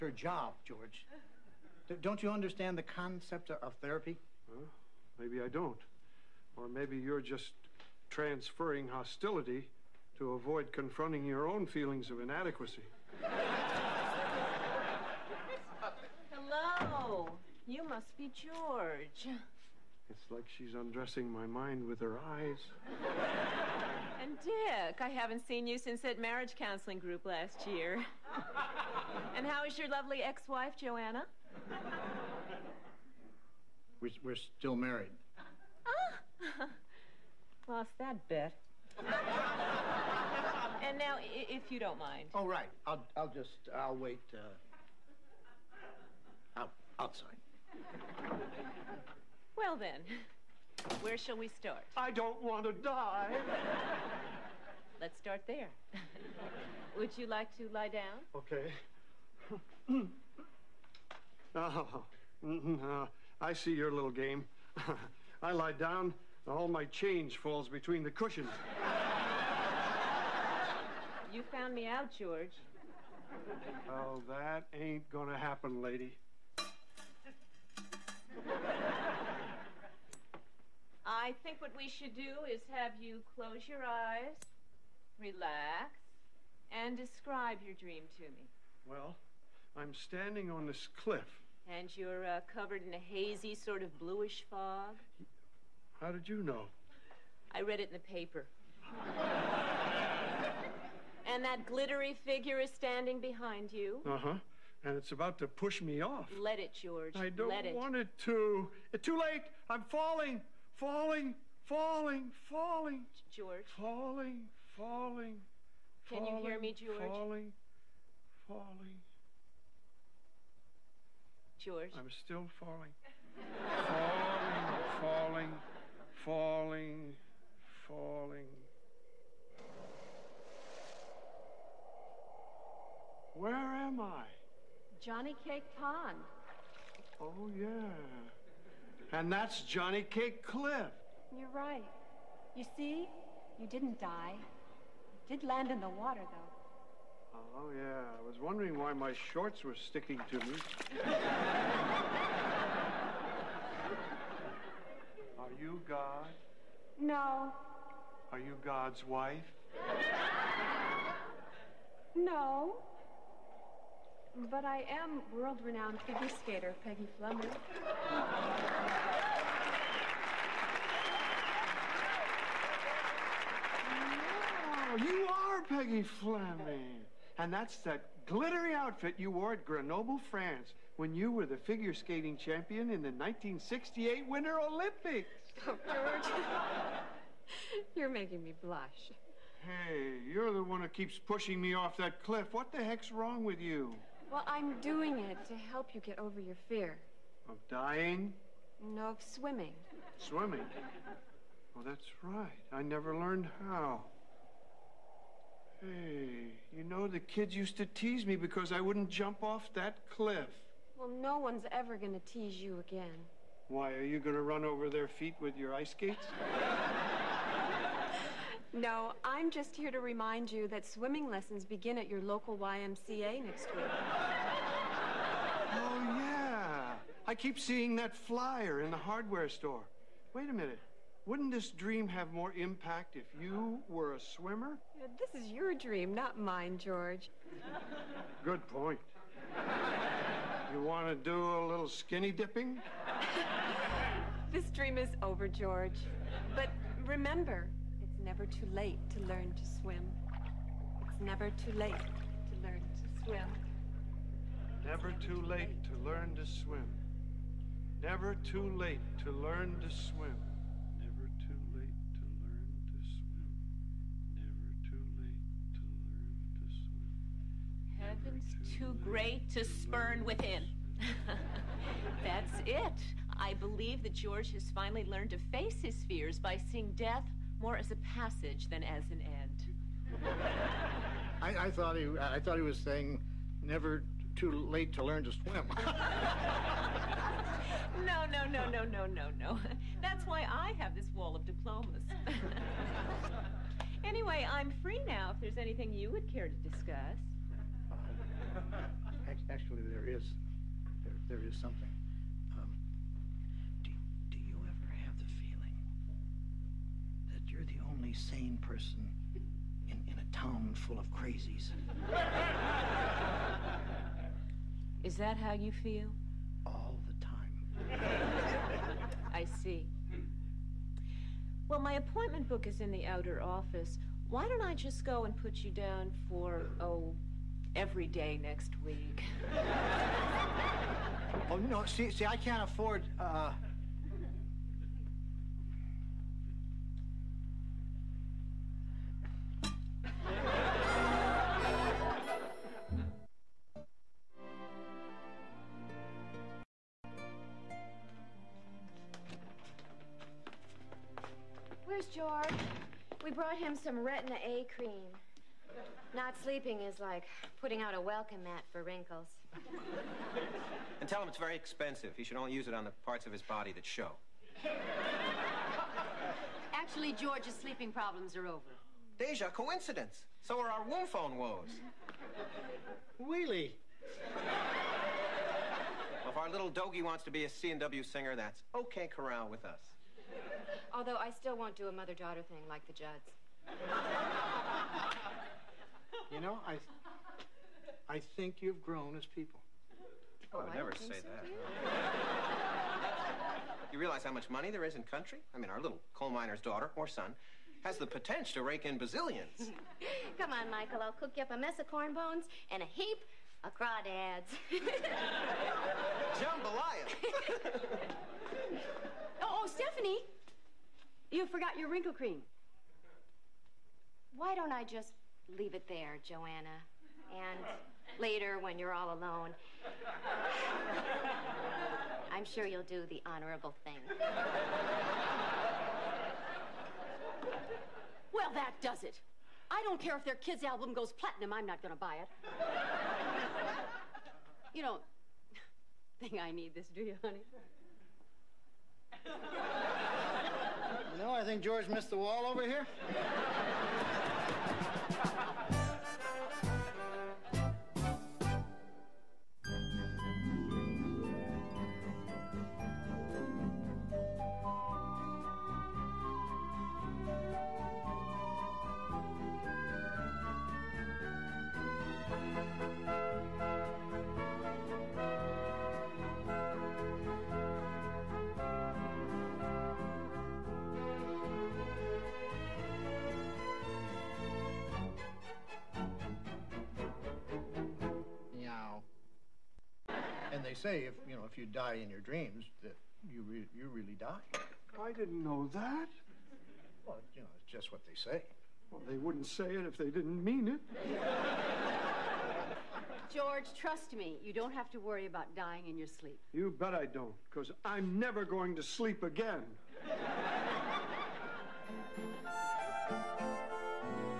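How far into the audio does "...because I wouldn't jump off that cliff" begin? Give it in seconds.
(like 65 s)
208 s.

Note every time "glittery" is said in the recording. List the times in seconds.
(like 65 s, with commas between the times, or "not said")
101 s, 178 s.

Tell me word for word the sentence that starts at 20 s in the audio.
It's like she's undressing my mind with her eyes.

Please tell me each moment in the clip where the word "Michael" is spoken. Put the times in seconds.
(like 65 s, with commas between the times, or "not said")
400 s.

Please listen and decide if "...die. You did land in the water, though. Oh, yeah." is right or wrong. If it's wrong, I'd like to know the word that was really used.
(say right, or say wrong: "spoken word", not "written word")
right.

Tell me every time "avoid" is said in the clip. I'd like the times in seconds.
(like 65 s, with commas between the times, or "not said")
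10 s.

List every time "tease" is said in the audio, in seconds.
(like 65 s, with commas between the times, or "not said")
207 s, 212 s.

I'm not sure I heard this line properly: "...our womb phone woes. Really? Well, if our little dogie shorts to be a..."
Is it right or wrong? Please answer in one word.
wrong.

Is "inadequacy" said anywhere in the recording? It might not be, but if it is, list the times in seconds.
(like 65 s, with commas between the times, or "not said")
12 s.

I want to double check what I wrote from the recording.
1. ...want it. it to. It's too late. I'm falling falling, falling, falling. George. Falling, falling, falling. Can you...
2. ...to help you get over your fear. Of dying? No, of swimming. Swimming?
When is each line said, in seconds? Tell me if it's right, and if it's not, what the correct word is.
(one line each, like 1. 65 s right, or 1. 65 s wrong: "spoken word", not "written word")
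1. 107 s right
2. 195 s right.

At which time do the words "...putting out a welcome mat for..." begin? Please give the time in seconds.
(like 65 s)
357 s.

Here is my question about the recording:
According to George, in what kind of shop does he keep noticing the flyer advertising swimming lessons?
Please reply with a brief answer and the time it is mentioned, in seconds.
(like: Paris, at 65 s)
hardware store, at 228 s.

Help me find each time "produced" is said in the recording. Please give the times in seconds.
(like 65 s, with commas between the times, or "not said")
not said.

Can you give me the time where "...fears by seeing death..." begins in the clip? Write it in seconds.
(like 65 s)
276 s.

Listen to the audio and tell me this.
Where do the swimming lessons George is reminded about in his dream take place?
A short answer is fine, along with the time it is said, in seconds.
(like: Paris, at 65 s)
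YMCA, at 222 s.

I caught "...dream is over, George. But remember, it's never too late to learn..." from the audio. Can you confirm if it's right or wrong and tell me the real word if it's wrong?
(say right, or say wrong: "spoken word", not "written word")
right.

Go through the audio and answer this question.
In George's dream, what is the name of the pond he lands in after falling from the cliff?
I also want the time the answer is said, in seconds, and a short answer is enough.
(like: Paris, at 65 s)
Johnny Cake Pond, at 135 s.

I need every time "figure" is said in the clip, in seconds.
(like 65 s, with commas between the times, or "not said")
102 s, 166 s, 181 s.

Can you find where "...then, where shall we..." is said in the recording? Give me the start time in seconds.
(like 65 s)
49 s.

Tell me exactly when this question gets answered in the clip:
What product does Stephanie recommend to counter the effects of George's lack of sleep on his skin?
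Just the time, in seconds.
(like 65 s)
353 s.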